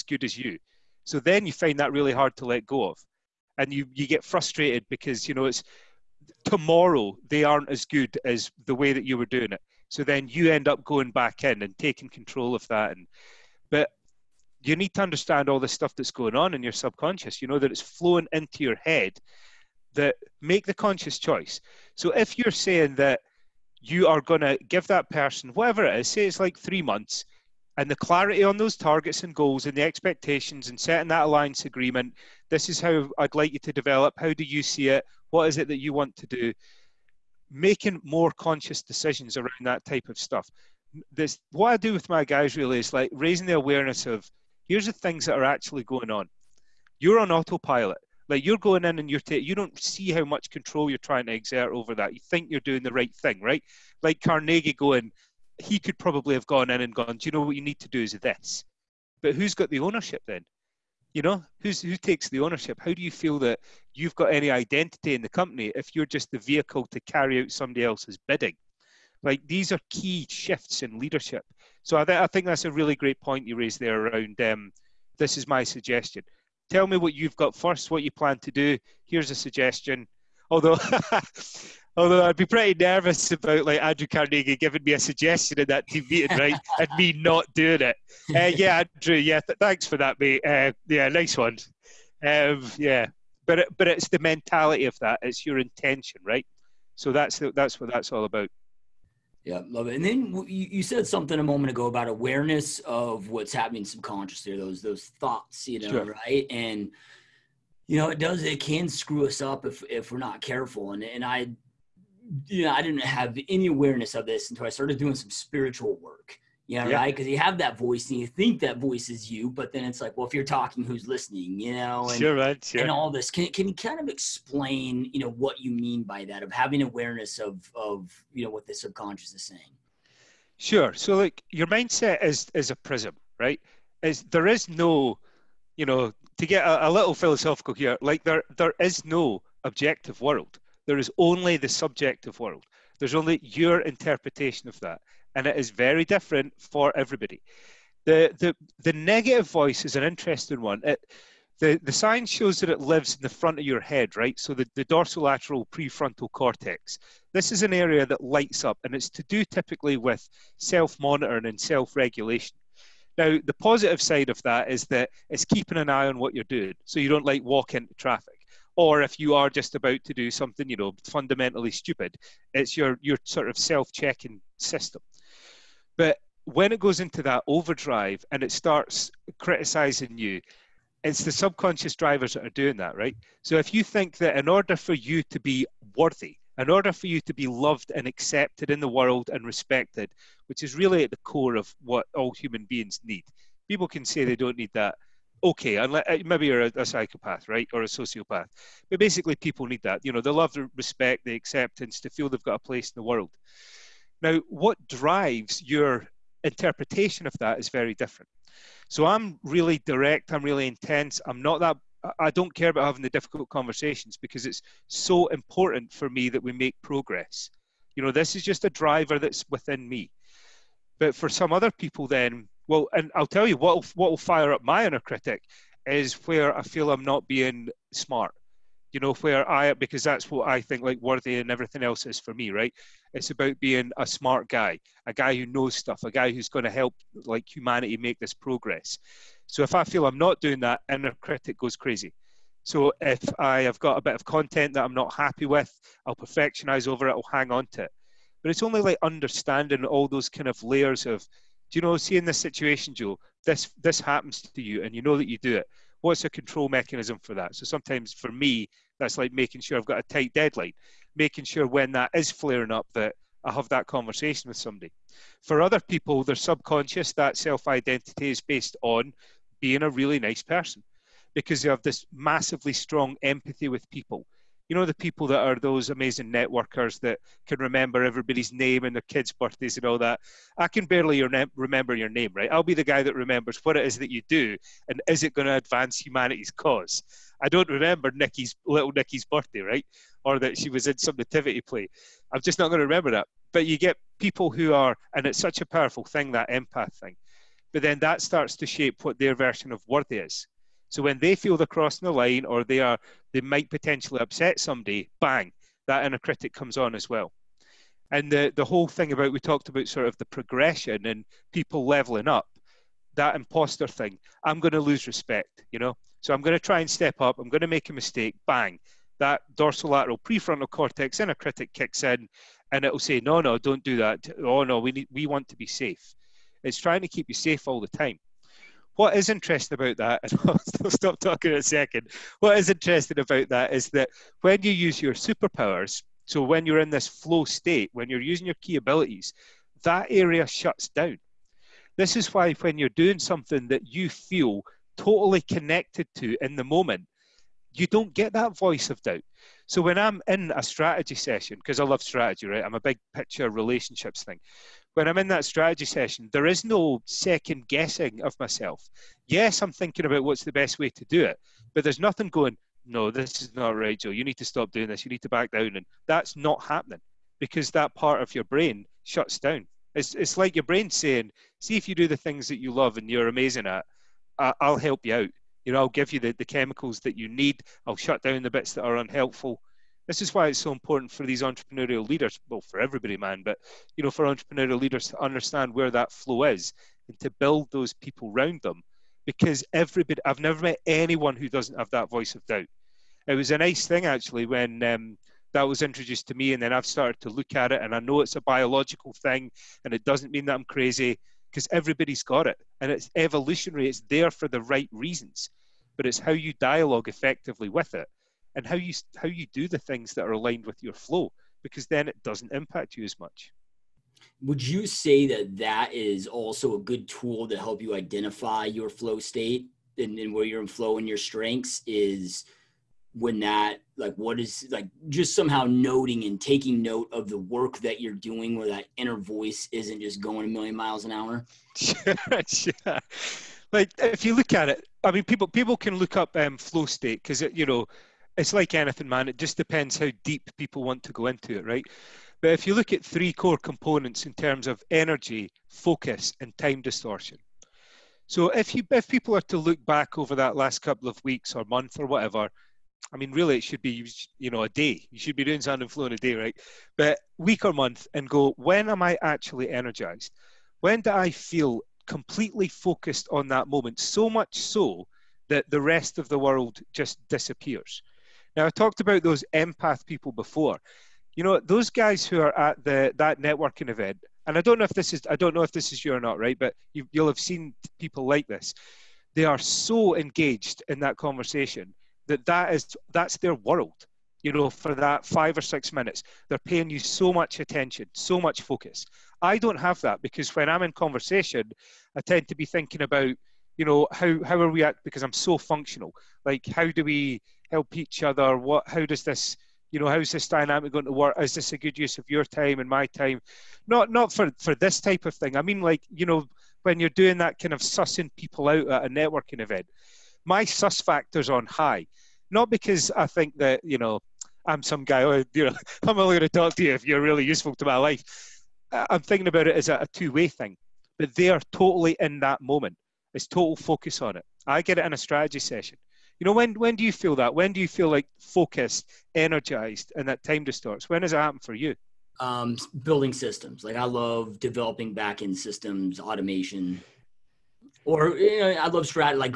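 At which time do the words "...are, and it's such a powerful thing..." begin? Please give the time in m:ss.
4:54.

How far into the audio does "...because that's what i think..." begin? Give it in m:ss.
3:49.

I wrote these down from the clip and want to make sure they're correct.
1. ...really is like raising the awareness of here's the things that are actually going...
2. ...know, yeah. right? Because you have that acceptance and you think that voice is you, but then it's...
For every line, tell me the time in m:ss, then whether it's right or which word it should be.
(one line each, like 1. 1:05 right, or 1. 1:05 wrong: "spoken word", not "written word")
1. 0:42 right
2. 1:56 wrong: "voice", not "acceptance".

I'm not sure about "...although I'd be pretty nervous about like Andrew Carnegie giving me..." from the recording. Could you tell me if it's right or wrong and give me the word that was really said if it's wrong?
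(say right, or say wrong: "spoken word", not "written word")
right.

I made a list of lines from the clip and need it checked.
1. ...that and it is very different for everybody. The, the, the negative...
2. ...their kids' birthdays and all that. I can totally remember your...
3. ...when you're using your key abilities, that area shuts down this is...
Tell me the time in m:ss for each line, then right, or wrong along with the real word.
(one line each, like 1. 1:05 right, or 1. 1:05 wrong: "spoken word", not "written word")
1. 2:24 right
2. 4:38 wrong: "barely", not "totally"
3. 5:37 right.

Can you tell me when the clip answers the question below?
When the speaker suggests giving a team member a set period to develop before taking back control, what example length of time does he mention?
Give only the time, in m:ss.
0:26.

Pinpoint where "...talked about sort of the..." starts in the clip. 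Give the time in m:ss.
5:09.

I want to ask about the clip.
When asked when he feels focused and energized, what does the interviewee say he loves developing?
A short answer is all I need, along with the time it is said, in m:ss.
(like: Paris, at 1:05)
back end systems, at 8:55.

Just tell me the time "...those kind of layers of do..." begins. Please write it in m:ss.
4:10.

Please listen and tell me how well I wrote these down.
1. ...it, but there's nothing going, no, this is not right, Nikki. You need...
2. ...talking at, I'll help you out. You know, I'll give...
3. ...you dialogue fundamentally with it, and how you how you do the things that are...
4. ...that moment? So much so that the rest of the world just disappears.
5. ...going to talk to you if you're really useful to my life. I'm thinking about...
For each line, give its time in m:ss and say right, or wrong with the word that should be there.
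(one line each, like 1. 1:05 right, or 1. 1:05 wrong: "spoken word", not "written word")
1. 6:01 wrong: "Joe", not "Nikki"
2. 6:13 wrong: "amazing", not "talking"
3. 6:46 wrong: "effectively", not "fundamentally"
4. 7:43 right
5. 8:36 right.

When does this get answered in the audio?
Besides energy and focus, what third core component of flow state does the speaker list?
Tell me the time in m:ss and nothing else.
7:26.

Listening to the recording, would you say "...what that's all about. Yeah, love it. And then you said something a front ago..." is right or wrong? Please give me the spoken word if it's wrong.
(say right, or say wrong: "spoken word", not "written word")
wrong: "moment", not "front".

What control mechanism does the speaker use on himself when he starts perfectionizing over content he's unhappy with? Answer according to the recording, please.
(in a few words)
a tight deadline.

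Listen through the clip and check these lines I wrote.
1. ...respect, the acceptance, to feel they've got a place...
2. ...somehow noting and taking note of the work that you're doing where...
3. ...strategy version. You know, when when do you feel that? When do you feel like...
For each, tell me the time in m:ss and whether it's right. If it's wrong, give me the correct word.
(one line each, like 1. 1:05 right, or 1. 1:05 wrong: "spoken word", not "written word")
1. 3:20 right
2. 7:05 right
3. 8:45 wrong: "session", not "version".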